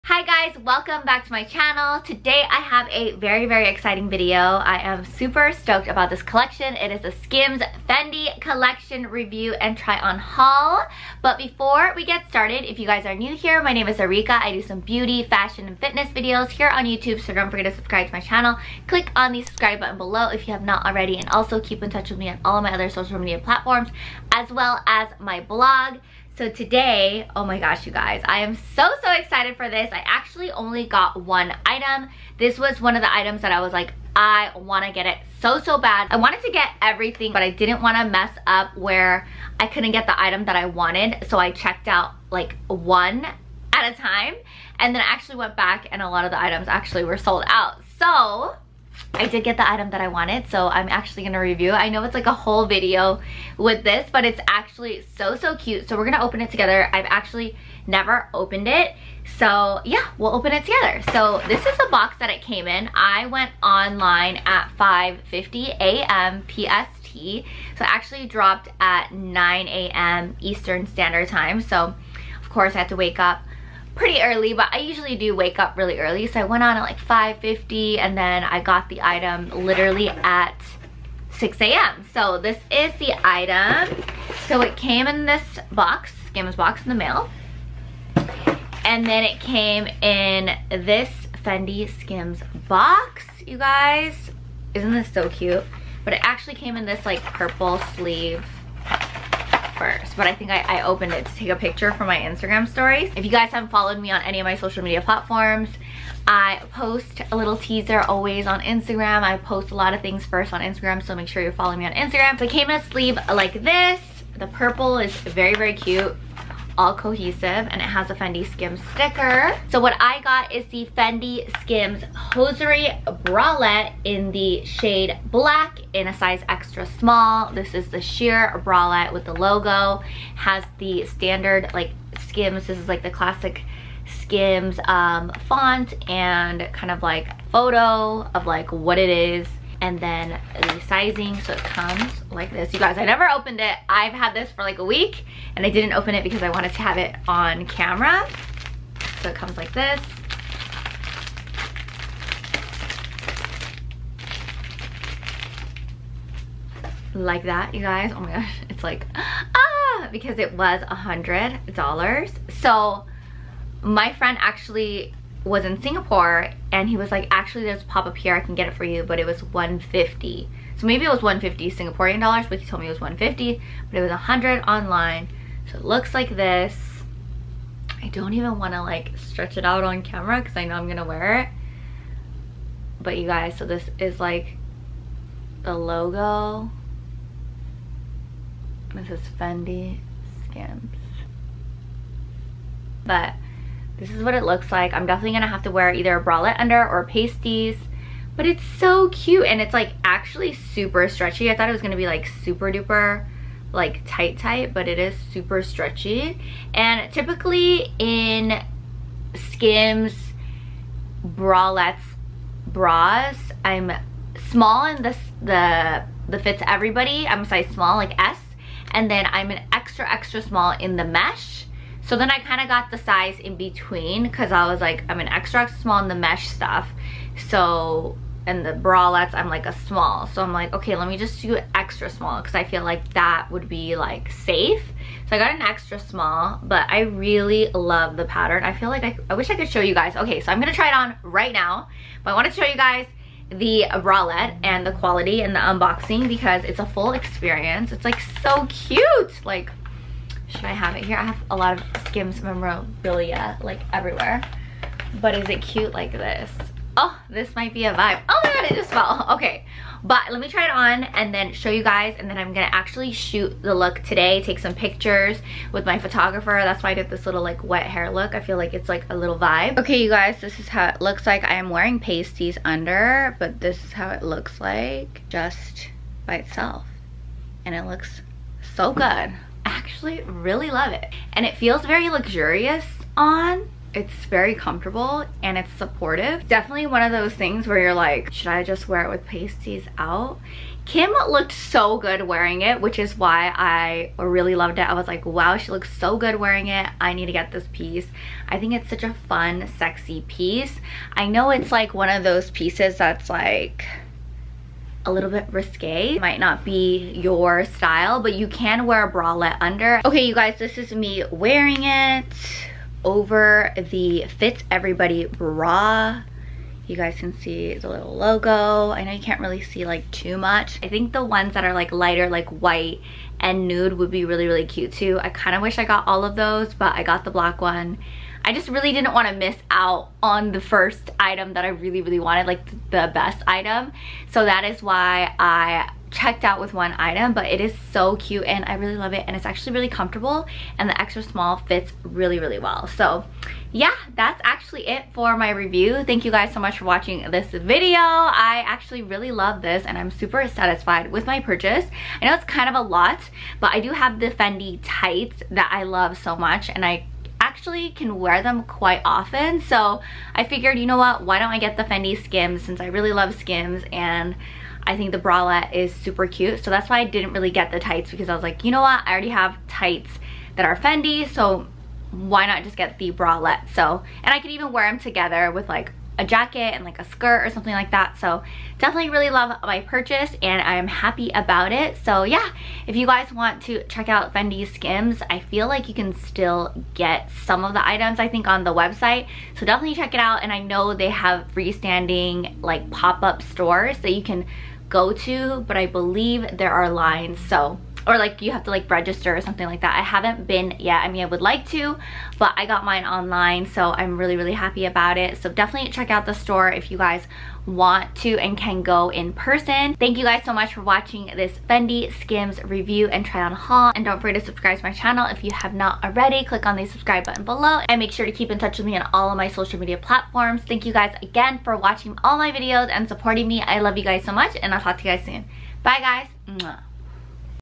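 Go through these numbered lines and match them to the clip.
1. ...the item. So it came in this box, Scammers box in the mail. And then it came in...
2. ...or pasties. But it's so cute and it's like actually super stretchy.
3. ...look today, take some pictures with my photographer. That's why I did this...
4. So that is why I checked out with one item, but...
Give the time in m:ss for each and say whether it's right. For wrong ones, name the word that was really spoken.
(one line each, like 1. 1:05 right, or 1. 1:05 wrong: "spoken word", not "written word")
1. 1:22 right
2. 3:16 right
3. 4:23 right
4. 5:34 right.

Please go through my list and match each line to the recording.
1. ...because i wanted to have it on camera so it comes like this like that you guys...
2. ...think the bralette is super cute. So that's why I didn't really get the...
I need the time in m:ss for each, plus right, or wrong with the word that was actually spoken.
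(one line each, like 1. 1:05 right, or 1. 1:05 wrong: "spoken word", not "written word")
1. 2:26 right
2. 6:04 right.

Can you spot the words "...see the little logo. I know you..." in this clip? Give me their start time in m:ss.
5:17.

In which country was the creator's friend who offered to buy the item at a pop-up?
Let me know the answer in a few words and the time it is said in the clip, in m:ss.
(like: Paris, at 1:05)
Singapore, at 2:45.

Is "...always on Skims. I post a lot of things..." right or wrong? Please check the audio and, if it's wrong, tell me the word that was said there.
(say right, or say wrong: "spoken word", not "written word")
wrong: "Instagram", not "Skims".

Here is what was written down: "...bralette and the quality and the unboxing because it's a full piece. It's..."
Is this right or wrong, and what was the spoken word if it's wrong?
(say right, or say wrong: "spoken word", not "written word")
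wrong: "experience", not "piece".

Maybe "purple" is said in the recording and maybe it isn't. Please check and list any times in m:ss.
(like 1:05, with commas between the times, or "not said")
1:37, 1:54.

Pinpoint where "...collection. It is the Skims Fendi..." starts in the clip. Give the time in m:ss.
0:06.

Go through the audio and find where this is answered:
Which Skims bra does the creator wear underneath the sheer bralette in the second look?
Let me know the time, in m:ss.
5:14.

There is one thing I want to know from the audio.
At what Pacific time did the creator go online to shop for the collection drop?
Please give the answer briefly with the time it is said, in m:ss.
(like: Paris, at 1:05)
5:50 a.m., at 1:04.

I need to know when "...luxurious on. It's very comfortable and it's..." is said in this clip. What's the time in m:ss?
4:42.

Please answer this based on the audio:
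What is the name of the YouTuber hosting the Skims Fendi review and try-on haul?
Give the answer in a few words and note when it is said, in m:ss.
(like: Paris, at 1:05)
Arika, at 0:13.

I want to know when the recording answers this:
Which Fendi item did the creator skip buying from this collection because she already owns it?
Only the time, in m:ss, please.
5:54.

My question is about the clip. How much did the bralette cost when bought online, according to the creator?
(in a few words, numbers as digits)
$100.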